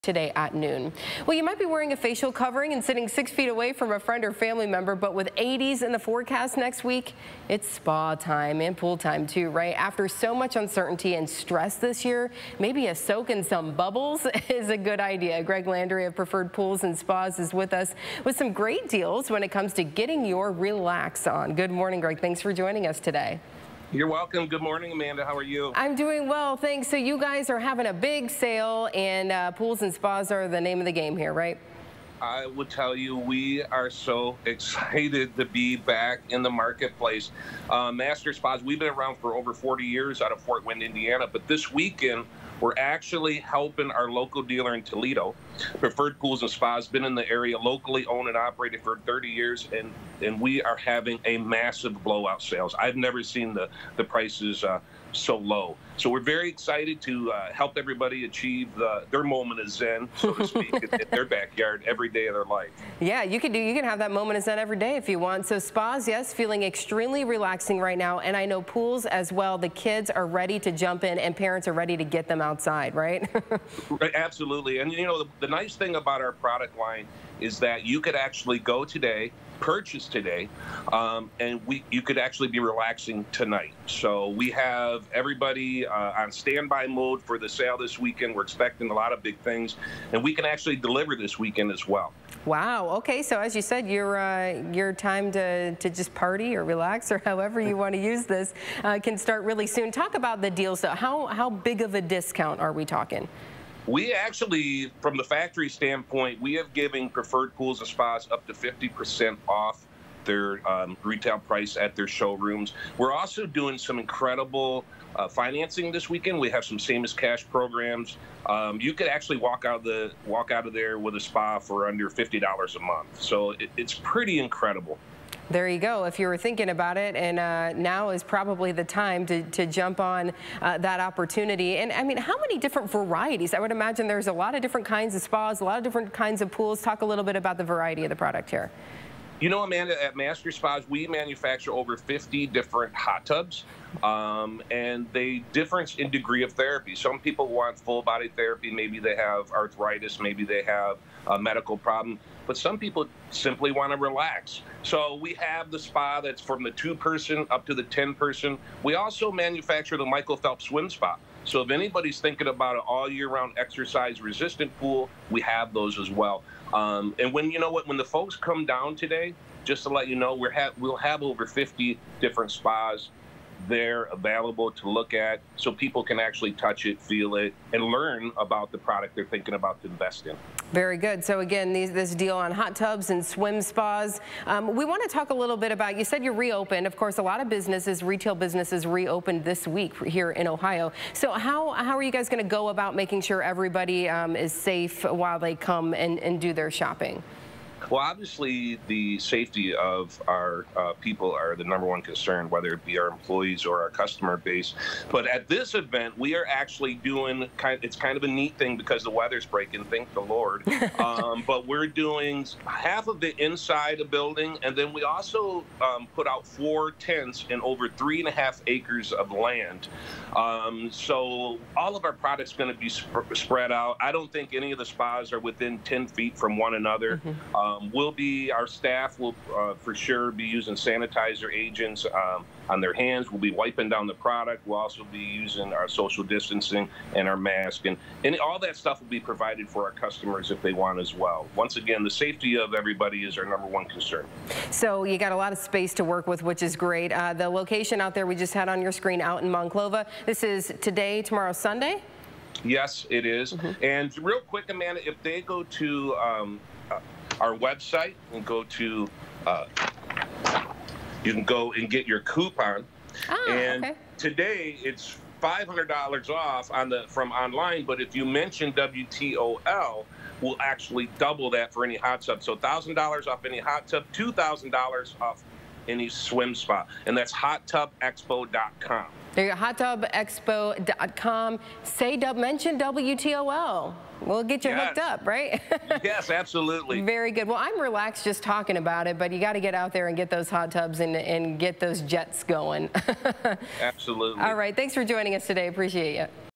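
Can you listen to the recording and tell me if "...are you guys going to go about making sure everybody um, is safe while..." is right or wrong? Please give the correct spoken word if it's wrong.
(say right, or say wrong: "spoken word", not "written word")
right.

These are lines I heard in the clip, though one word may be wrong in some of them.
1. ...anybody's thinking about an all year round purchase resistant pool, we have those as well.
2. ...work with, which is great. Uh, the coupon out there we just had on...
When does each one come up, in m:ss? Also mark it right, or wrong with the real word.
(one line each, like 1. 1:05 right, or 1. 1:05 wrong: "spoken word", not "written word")
1. 2:41 wrong: "exercise", not "purchase"
2. 4:06 wrong: "location", not "coupon".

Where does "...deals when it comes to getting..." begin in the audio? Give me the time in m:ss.
0:18.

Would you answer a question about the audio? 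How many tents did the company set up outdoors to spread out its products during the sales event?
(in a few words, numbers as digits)
4.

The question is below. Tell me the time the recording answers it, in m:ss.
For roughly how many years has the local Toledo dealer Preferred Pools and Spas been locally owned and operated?
0:48.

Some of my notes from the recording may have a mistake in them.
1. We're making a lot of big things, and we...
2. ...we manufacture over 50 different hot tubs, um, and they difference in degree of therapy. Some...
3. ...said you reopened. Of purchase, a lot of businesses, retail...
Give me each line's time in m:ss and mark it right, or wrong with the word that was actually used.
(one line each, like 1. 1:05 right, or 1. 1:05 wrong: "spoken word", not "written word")
1. 1:28 wrong: "expecting", not "making"
2. 2:20 right
3. 3:06 wrong: "course", not "purchase".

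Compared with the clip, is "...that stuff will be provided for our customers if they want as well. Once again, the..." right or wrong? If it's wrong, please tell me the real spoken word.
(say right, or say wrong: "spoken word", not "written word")
right.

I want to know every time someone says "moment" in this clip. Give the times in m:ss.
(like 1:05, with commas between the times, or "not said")
0:59, 1:04.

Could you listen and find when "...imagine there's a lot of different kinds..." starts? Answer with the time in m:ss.
2:13.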